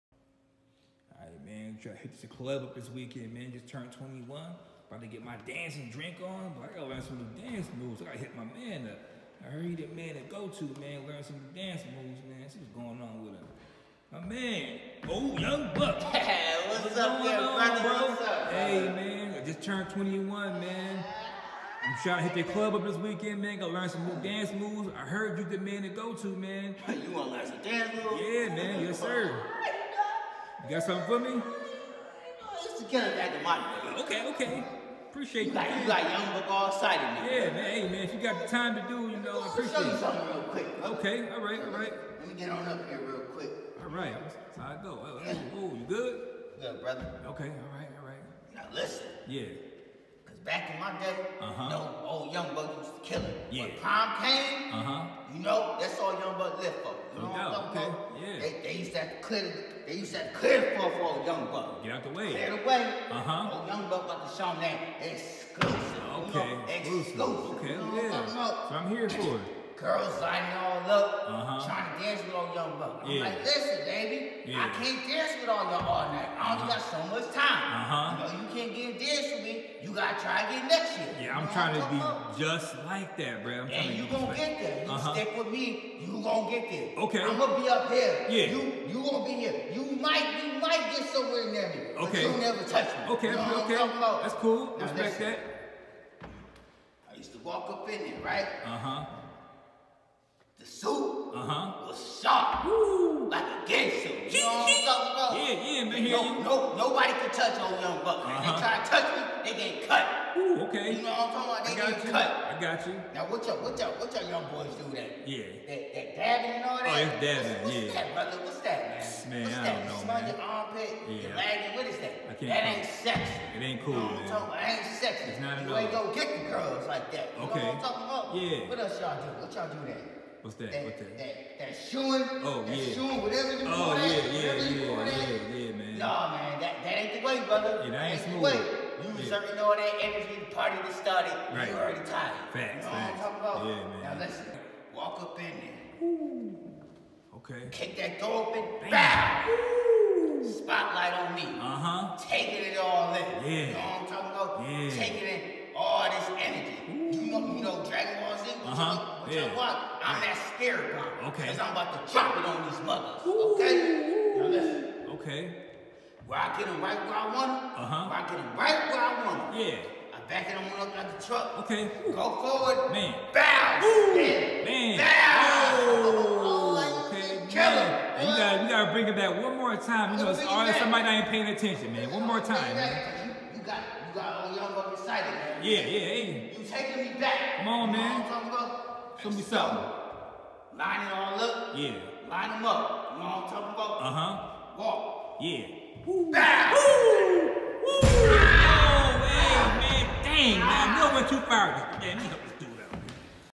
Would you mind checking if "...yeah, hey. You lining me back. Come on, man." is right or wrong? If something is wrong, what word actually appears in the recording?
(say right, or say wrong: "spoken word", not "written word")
wrong: "taking", not "lining".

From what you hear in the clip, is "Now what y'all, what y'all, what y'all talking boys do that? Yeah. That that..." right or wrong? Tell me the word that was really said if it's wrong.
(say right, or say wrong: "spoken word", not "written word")
wrong: "young", not "talking".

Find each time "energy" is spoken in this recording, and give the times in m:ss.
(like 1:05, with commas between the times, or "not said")
2:20, 2:36.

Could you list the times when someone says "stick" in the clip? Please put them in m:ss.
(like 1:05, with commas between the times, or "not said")
1:25.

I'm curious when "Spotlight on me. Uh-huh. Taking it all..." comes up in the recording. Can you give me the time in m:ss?
2:30.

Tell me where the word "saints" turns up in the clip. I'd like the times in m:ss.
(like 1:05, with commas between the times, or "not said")
not said.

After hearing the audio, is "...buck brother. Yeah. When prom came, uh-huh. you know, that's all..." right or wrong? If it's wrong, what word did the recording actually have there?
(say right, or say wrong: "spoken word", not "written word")
wrong: "killer", not "brother".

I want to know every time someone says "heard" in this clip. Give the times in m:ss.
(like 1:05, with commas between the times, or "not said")
0:09, 0:25.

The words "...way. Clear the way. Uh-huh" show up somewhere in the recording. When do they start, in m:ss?
1:02.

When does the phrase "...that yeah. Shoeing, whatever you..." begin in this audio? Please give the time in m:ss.
2:12.